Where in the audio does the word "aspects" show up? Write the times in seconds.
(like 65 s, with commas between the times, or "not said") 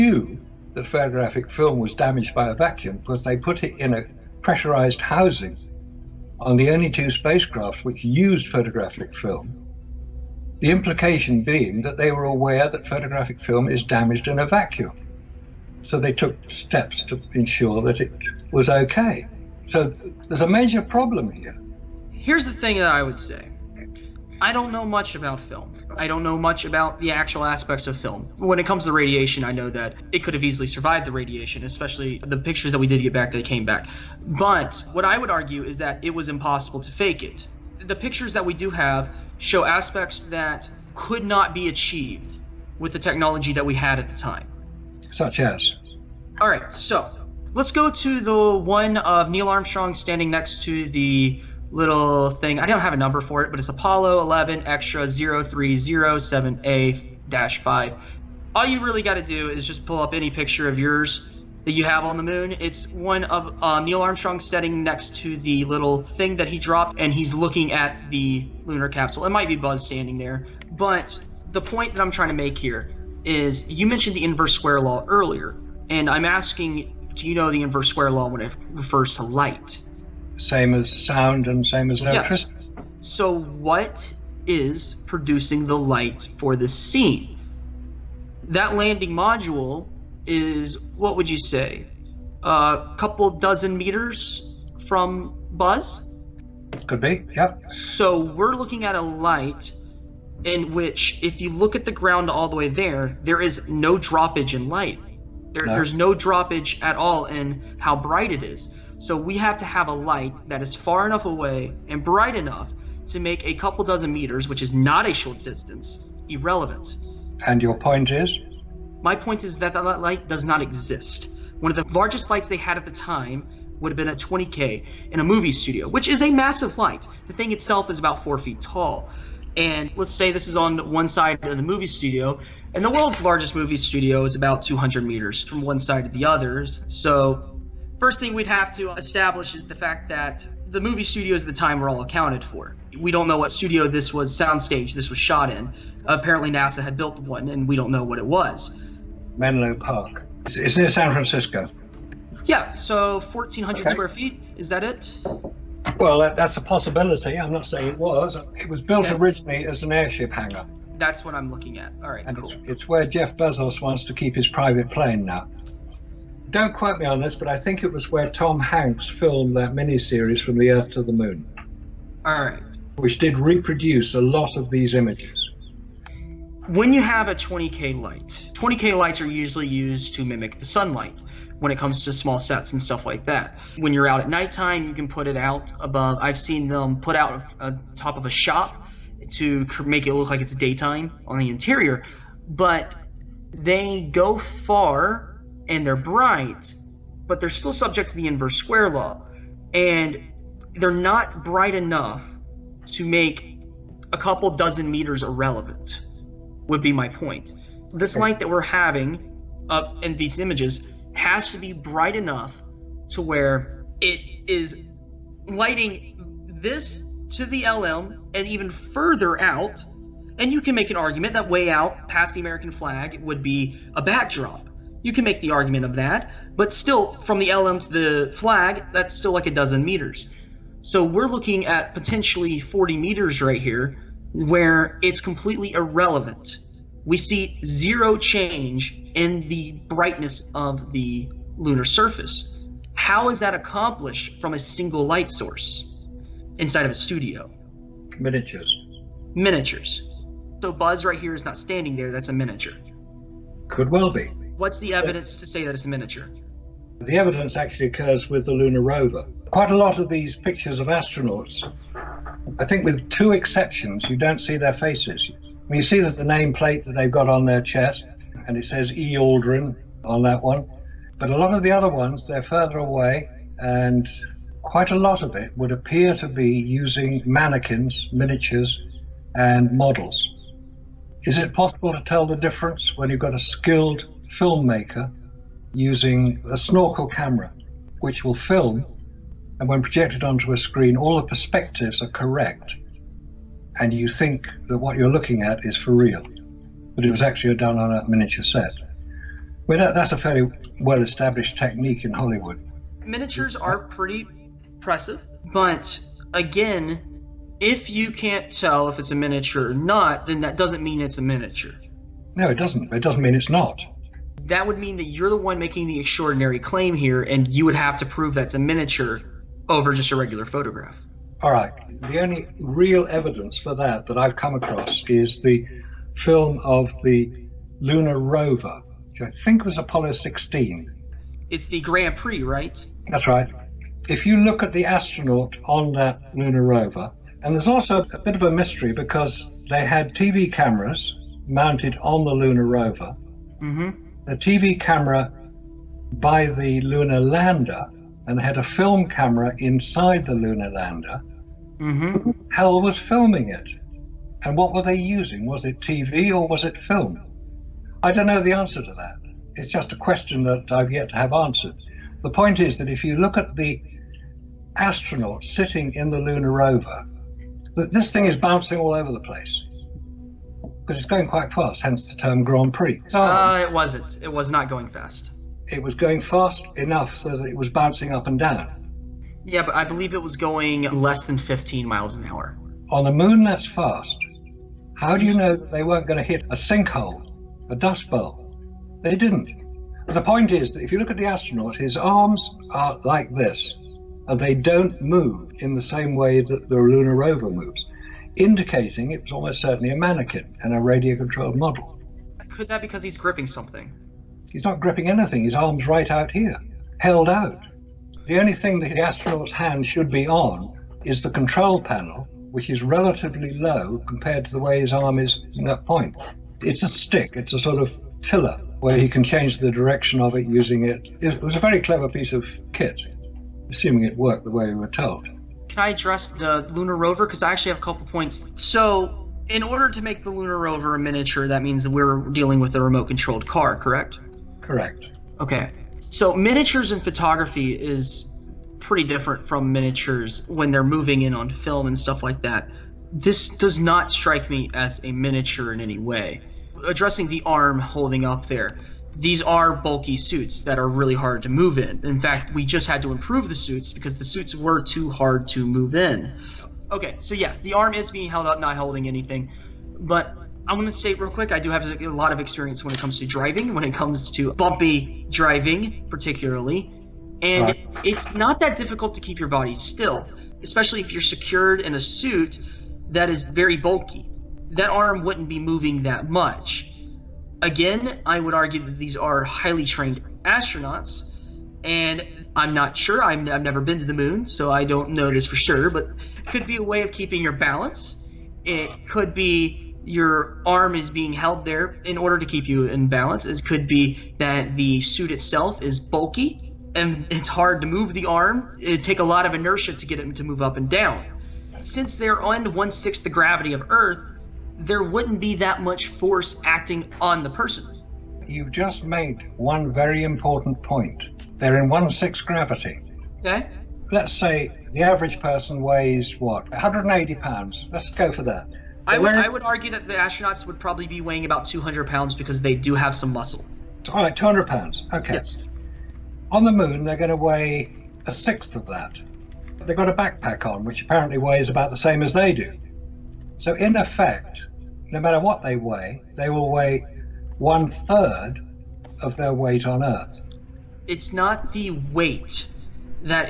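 27 s, 39 s.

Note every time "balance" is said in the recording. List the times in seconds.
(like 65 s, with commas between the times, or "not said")
487 s, 493 s.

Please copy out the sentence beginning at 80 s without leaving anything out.
Same as sound and same as electricity.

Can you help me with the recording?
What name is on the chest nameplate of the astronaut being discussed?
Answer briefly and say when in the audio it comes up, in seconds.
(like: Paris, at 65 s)
E. Aldrin, at 268 s.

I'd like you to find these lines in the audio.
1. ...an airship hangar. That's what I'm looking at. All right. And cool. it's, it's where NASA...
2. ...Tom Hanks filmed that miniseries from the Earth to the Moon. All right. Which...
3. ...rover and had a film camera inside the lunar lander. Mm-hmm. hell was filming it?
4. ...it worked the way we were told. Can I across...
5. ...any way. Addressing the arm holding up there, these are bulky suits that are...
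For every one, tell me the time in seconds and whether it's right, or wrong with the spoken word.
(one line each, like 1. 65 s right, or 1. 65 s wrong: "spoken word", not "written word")
1. 159 s wrong: "Jeff", not "NASA"
2. 168 s right
3. 347 s wrong: "lander", not "rover"
4. 424 s wrong: "address", not "across"
5. 445 s right.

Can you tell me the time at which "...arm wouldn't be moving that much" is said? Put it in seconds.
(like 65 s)
474 s.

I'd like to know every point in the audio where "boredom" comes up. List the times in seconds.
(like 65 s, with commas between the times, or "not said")
not said.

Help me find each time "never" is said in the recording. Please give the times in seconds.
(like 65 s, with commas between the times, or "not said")
483 s.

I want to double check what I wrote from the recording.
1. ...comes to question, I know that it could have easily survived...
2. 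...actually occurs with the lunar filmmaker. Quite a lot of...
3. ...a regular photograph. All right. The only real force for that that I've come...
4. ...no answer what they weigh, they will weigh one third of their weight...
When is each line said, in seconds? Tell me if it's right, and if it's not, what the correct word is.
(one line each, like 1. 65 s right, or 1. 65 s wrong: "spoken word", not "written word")
1. 28 s wrong: "radiation", not "question"
2. 257 s wrong: "rover", not "filmmaker"
3. 320 s wrong: "evidence", not "force"
4. 535 s wrong: "matter", not "answer".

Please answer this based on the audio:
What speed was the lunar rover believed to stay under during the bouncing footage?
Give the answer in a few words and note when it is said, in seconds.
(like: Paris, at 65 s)
15 miles an hour, at 381 s.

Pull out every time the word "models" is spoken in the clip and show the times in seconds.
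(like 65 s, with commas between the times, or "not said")
279 s, 401 s.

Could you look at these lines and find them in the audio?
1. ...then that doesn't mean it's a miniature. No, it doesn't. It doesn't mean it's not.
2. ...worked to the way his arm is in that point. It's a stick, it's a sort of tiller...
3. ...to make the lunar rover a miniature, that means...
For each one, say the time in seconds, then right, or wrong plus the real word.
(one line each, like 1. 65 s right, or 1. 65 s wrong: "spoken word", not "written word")
1. 310 s right
2. 414 s wrong: "compared", not "worked"
3. 429 s right.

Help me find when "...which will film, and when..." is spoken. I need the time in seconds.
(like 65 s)
288 s.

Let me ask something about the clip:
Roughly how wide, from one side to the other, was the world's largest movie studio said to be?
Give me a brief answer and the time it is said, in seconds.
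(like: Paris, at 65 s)
200 meters, at 134 s.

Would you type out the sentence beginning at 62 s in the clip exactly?
It's one of uh, Neil Armstrong standing next to the little thing that he dropped, and he's looking at the lunar capsule.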